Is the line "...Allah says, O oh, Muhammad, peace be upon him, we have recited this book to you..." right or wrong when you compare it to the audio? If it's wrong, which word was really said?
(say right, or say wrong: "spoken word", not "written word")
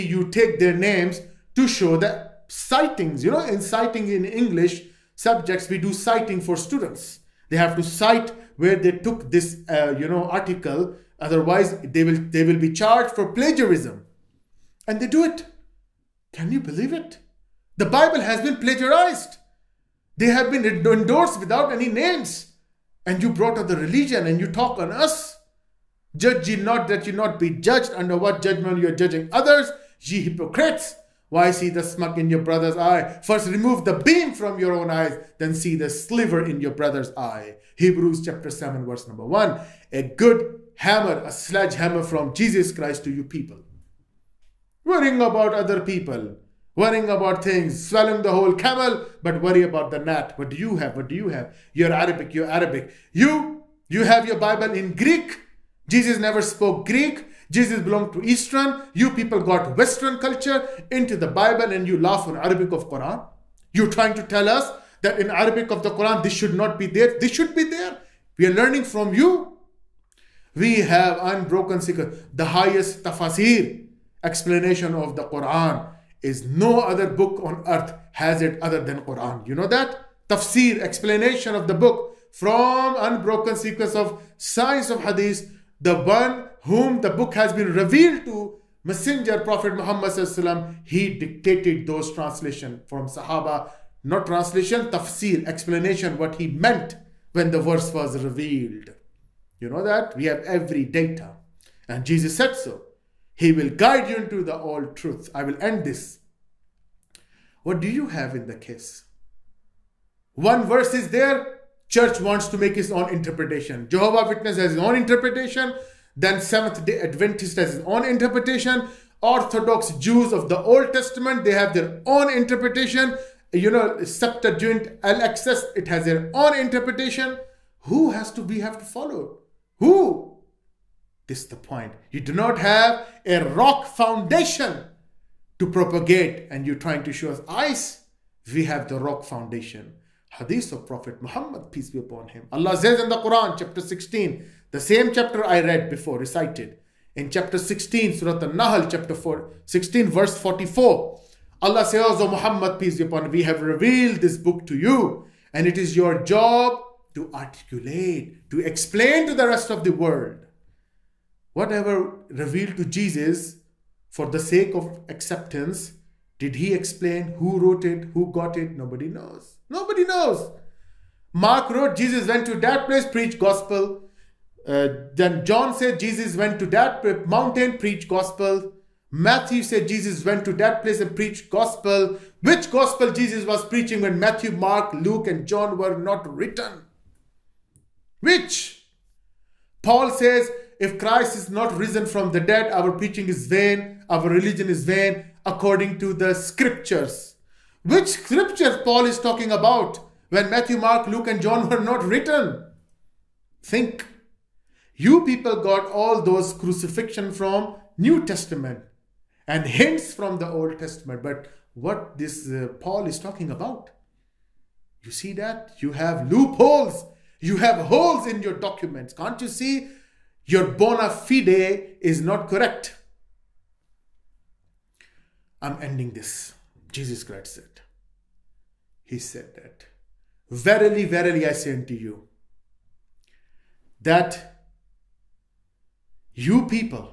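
wrong: "revealed", not "recited".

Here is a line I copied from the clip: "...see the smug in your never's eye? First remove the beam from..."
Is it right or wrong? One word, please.
wrong.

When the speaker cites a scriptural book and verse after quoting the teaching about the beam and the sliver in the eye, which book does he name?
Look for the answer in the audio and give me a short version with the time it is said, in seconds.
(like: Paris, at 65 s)
Hebrews, at 37 s.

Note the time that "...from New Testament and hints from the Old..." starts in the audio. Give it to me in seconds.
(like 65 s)
207 s.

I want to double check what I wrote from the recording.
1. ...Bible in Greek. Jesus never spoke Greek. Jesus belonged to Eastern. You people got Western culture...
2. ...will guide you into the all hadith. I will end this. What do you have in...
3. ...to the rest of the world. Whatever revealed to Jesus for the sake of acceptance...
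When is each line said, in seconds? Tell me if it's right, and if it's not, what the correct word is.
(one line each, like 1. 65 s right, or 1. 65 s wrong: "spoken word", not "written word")
1. 54 s right
2. 103 s wrong: "truth", not "hadith"
3. 159 s right.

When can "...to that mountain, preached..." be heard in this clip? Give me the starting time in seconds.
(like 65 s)
176 s.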